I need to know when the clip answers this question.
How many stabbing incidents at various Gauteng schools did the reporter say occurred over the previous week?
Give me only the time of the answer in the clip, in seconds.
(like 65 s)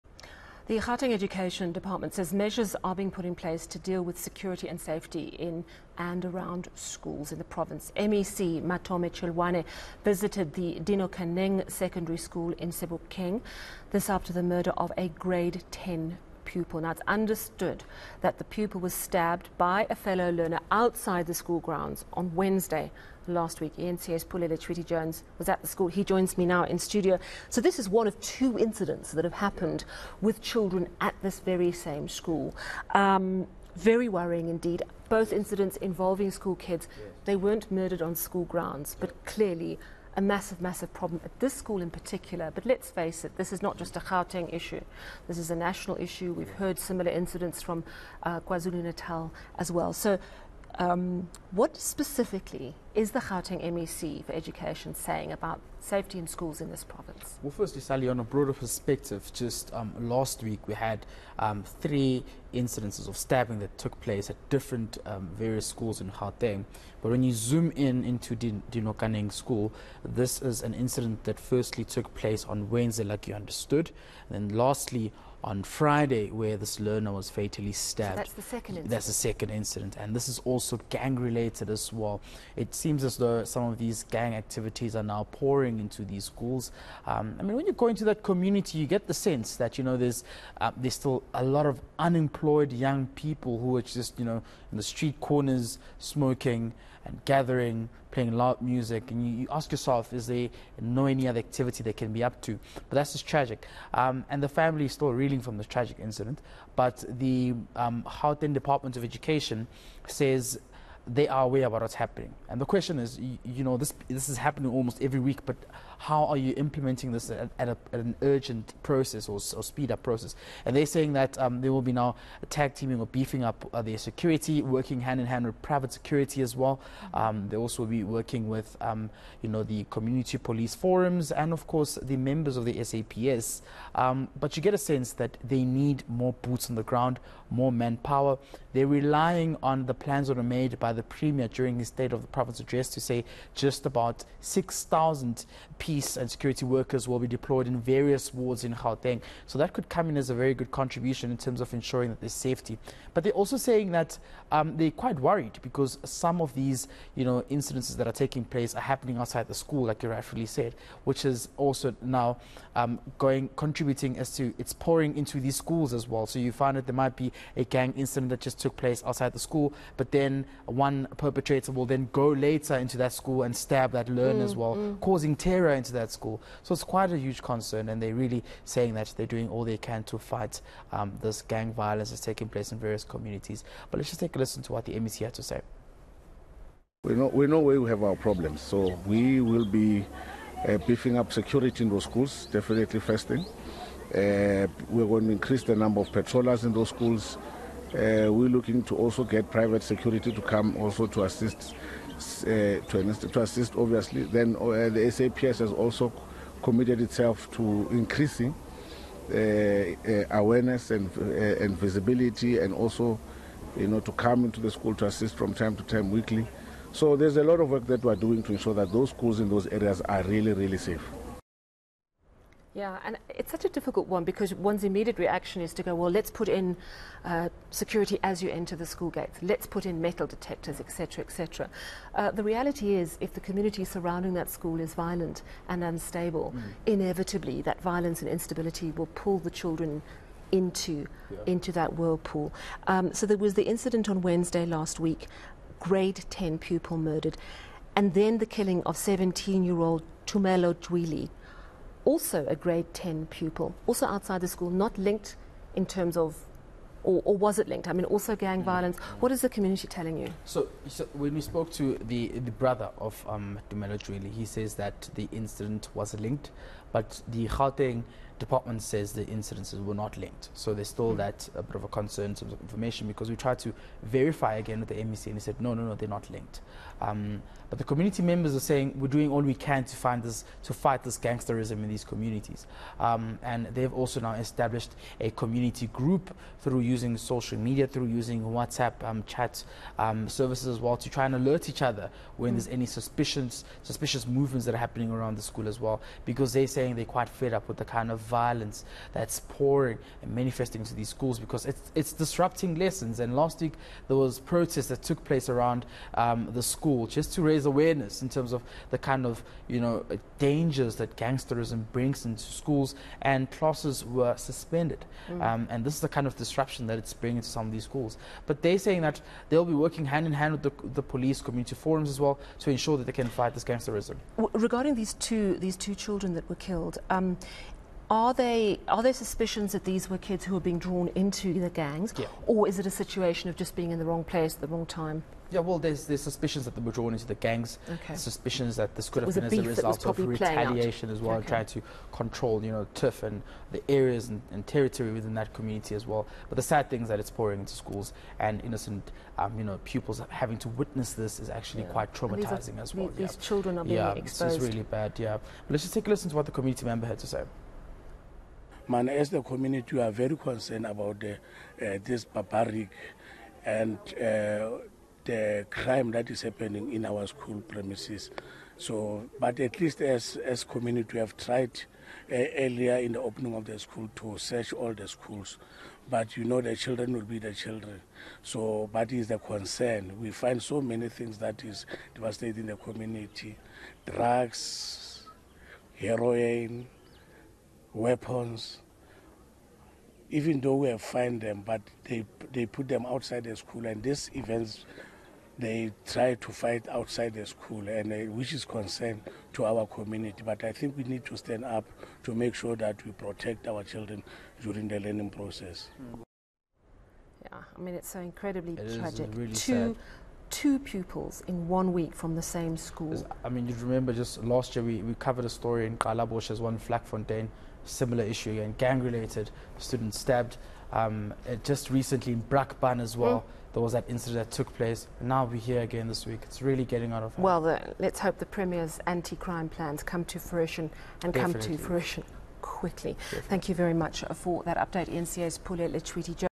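61 s.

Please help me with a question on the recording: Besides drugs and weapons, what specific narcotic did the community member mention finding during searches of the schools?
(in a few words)
heroin.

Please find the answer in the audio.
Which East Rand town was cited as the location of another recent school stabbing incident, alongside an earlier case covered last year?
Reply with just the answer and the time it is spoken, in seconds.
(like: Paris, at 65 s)
Brakpan, at 422 s.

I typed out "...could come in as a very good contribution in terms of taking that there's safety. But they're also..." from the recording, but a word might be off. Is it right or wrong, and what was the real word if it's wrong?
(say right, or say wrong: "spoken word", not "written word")
wrong: "ensuring", not "taking".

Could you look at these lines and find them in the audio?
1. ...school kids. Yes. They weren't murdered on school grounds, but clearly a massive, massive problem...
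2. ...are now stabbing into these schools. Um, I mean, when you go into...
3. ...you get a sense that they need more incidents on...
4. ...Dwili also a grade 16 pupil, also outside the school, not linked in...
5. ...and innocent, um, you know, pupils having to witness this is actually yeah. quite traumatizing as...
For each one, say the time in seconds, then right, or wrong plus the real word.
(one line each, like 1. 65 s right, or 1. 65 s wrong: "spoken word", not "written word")
1. 36 s right
2. 84 s wrong: "pouring", not "stabbing"
3. 134 s wrong: "boots", not "incidents"
4. 250 s wrong: "10", not "16"
5. 348 s right.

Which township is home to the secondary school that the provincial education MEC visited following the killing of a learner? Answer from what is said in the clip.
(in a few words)
Sebokeng.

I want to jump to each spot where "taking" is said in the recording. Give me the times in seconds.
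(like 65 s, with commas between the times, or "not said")
158 s, 182 s.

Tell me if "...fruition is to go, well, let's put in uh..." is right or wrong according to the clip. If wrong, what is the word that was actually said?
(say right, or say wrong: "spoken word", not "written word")
wrong: "reaction", not "fruition".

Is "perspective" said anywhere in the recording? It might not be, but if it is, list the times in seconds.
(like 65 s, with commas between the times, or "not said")
58 s.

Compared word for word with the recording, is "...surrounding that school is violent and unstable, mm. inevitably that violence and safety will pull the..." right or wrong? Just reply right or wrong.
wrong.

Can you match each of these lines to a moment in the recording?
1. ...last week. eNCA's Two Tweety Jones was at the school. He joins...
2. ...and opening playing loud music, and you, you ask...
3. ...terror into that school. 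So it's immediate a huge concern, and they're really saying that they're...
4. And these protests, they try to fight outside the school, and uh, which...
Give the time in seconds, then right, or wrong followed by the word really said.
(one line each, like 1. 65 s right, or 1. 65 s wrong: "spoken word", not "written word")
1. 23 s wrong: "Pulele", not "Two"
2. 97 s wrong: "gathering", not "opening"
3. 175 s wrong: "quite", not "immediate"
4. 393 s wrong: "events", not "protests".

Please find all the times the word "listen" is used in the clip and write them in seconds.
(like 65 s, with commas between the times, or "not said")
184 s, 356 s.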